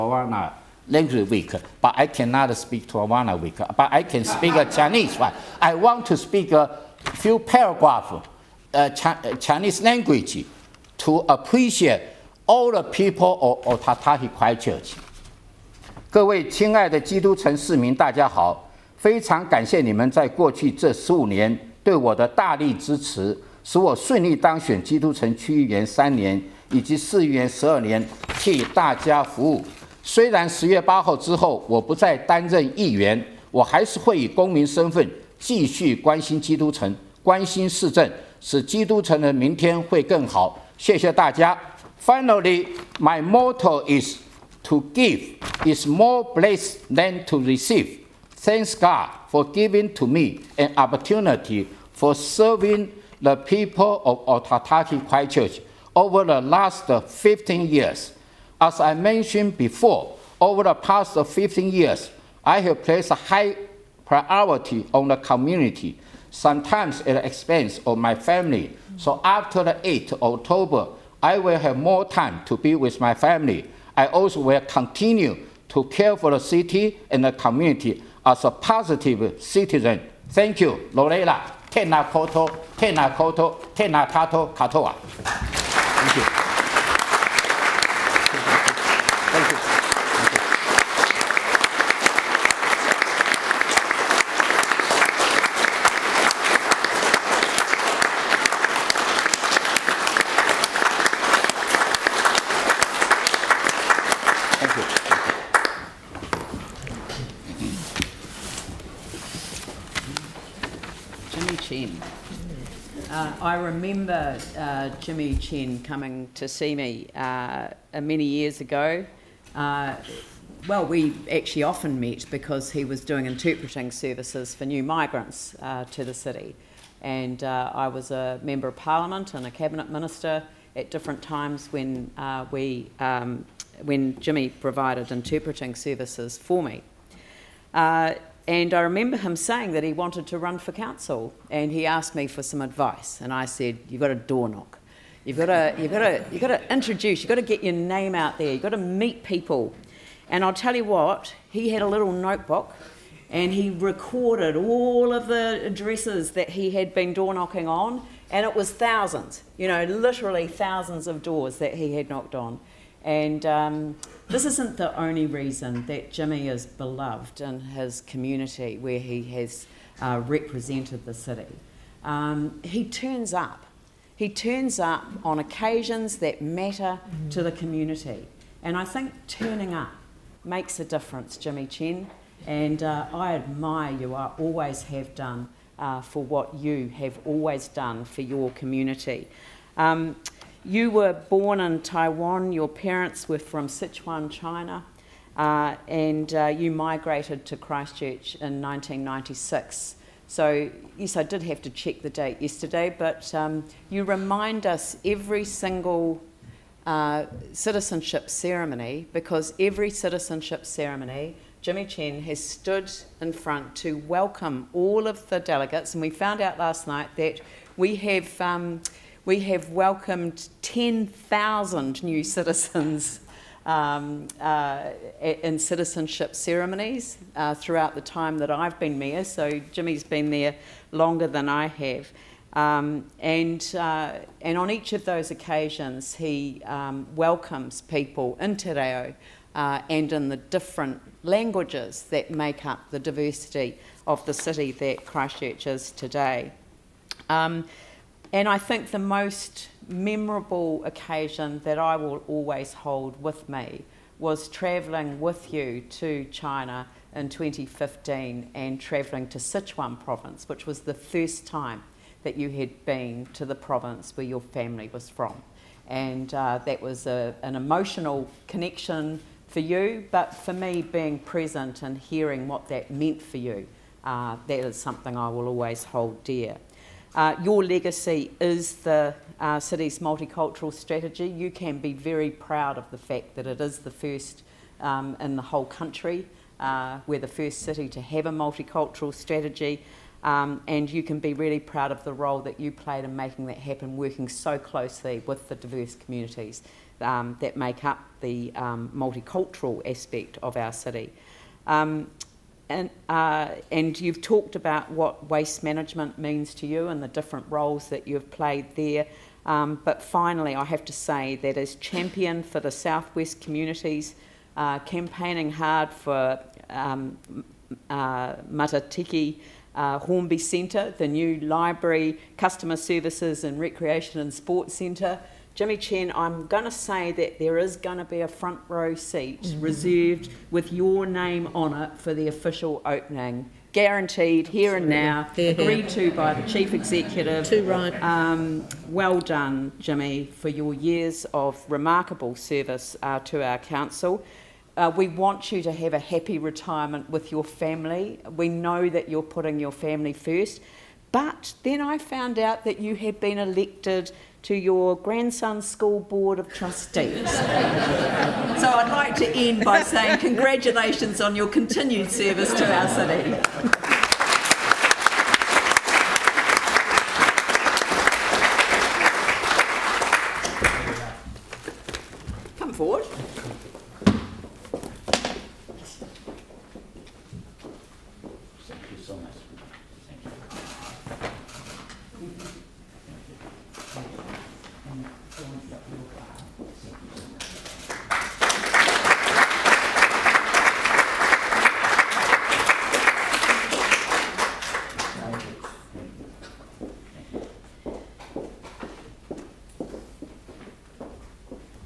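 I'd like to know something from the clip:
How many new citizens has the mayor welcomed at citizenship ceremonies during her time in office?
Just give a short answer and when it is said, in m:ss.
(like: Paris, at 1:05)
10,000, at 3:40.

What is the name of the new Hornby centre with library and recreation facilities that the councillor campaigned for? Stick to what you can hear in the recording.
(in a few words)
Matatiki.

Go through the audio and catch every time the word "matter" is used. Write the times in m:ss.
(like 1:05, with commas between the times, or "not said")
2:56.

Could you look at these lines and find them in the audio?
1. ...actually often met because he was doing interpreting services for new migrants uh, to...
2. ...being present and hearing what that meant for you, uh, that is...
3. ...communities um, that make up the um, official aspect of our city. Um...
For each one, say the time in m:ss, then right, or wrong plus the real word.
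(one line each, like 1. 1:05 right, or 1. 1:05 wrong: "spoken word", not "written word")
1. 2:01 right
2. 4:30 right
3. 4:55 wrong: "multicultural", not "official".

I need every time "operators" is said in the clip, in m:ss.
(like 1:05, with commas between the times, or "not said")
not said.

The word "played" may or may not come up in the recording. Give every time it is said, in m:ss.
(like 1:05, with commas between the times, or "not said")
4:52, 5:08.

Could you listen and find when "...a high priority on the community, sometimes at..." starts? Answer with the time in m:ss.
1:03.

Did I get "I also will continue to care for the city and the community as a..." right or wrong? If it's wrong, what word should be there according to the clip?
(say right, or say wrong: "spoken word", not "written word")
right.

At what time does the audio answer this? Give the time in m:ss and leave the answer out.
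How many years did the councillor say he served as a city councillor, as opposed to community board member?
0:27.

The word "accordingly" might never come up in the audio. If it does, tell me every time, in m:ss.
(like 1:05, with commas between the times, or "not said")
not said.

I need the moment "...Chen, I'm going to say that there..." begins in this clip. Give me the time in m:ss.
5:25.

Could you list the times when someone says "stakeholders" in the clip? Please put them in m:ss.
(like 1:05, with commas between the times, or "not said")
not said.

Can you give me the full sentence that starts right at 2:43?
And um, this isn't the only reason that Jimmy is beloved in his community where he has uh, represented the city.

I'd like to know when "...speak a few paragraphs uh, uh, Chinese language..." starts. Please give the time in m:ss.
0:06.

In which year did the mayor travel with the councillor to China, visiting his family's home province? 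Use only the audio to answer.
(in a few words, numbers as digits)
2015.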